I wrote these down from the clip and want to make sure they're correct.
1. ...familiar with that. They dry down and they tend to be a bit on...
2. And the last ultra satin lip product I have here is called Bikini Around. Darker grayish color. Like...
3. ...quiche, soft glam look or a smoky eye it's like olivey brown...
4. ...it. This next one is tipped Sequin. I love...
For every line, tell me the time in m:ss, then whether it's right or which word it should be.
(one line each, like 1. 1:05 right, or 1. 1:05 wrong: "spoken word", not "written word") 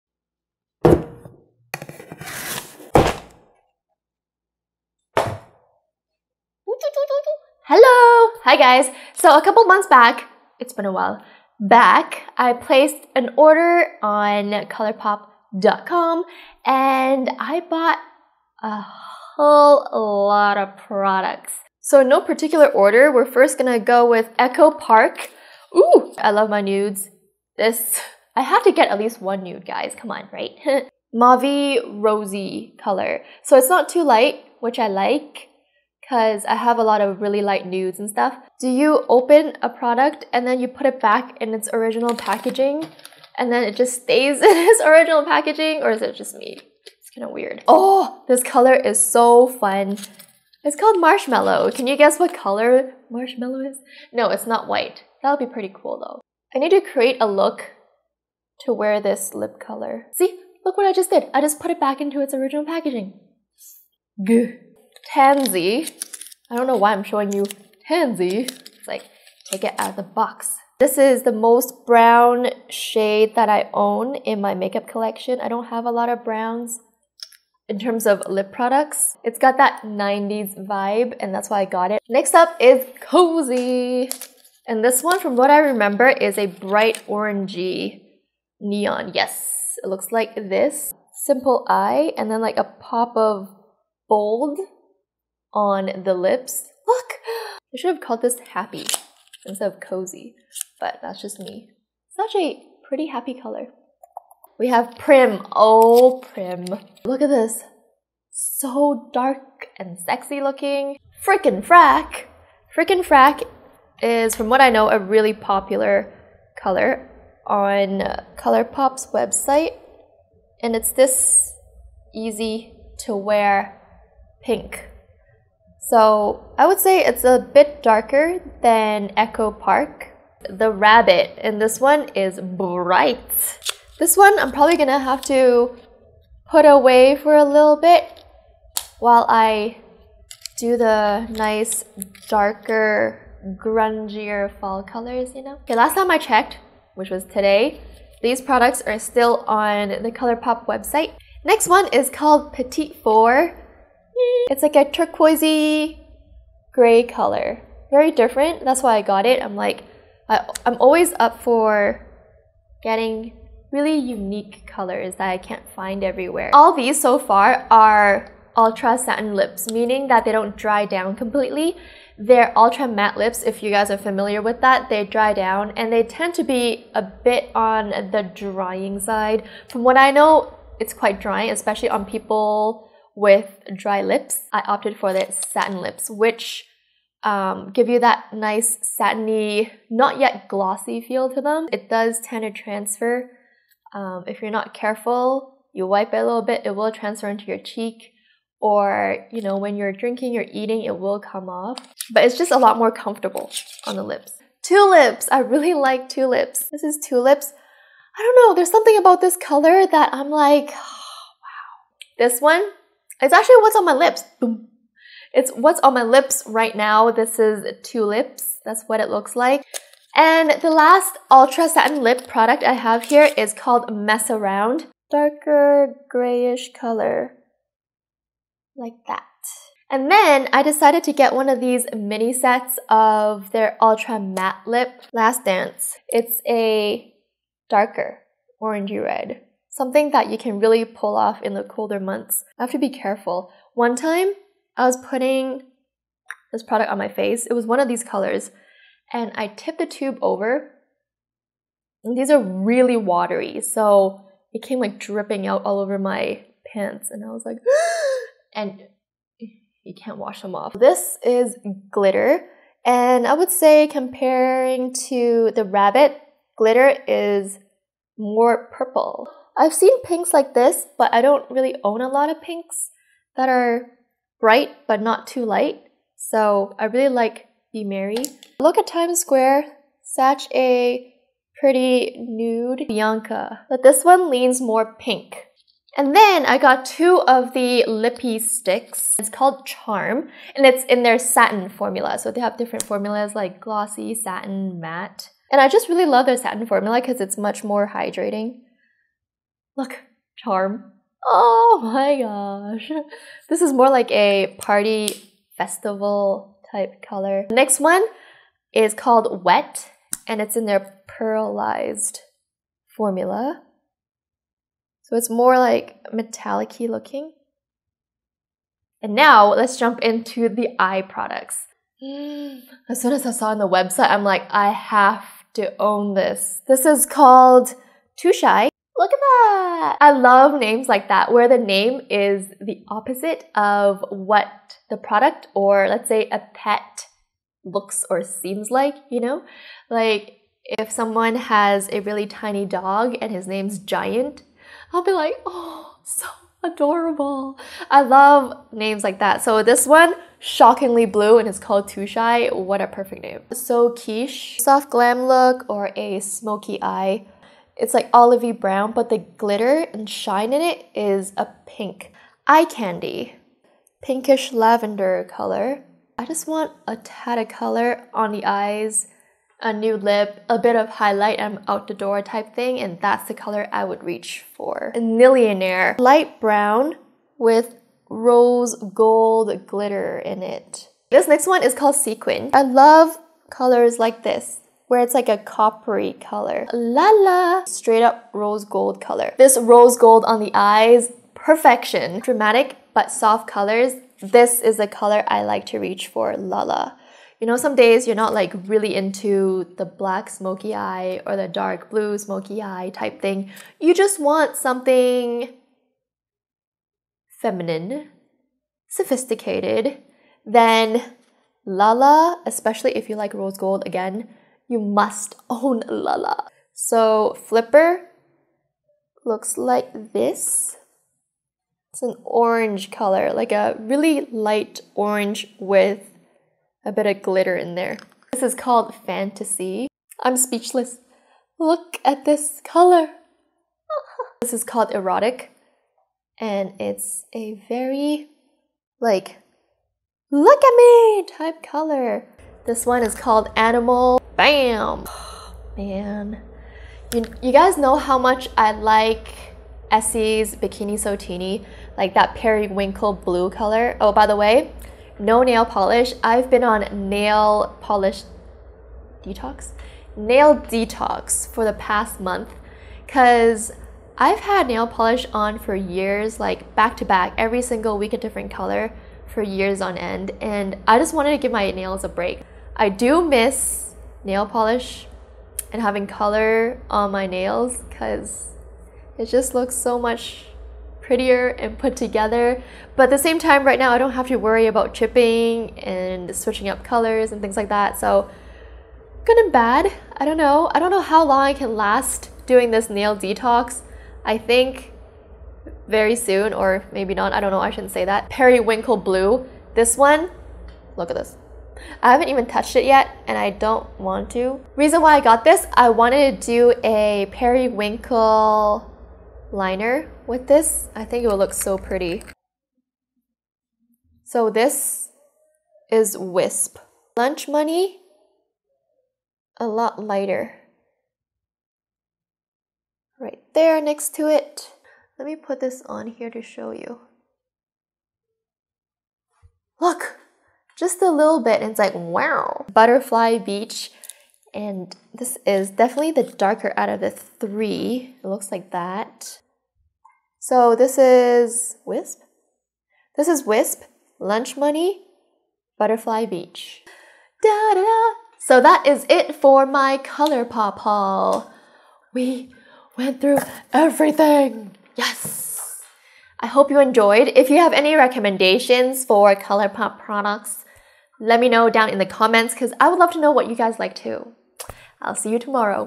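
1. 2:53 right
2. 3:40 wrong: "Mess", not "Bikini"
3. 5:53 right
4. 6:20 wrong: "called", not "tipped".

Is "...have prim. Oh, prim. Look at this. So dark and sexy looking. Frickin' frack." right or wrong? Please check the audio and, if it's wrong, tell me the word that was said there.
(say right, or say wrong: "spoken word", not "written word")
right.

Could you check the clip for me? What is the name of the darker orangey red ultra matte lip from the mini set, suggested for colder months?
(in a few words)
Last Dance.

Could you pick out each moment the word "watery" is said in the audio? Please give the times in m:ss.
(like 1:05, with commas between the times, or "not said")
4:12.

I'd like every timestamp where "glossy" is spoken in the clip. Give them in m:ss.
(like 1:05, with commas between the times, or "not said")
3:10, 4:53.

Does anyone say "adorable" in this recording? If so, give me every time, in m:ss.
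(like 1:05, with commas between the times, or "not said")
5:46.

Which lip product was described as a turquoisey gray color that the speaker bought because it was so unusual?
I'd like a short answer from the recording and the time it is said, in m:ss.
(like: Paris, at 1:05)
Petite Four, at 2:32.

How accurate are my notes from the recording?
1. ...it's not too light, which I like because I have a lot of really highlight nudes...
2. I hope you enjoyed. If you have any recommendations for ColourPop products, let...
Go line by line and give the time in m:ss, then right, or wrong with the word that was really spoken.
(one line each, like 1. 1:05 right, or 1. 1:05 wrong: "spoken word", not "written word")
1. 0:33 wrong: "light", not "highlight"
2. 9:16 right.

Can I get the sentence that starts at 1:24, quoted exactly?
And this one, from what I remember, is a bright orangey neon.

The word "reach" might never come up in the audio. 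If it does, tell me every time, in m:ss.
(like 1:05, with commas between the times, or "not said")
6:14, 6:35.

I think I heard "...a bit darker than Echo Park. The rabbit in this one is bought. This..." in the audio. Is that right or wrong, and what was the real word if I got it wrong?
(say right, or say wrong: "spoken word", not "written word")
wrong: "bright", not "bought".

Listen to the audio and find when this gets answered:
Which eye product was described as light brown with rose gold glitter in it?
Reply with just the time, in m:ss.
6:14.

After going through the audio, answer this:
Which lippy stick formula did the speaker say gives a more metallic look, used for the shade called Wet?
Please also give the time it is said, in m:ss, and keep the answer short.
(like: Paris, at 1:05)
pearlized, at 5:11.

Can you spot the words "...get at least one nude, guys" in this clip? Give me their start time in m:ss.
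0:28.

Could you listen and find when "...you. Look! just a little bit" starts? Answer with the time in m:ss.
8:46.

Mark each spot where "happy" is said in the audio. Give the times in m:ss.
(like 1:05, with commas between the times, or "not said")
1:38, 1:43.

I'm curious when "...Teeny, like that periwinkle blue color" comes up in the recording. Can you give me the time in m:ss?
7:31.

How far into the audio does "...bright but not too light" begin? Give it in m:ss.
4:34.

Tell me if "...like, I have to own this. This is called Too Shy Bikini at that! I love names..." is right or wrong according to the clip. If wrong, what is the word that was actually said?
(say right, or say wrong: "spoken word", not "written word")
wrong: "Look", not "Bikini".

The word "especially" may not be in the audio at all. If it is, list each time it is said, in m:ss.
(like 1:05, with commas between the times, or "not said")
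3:01, 6:52.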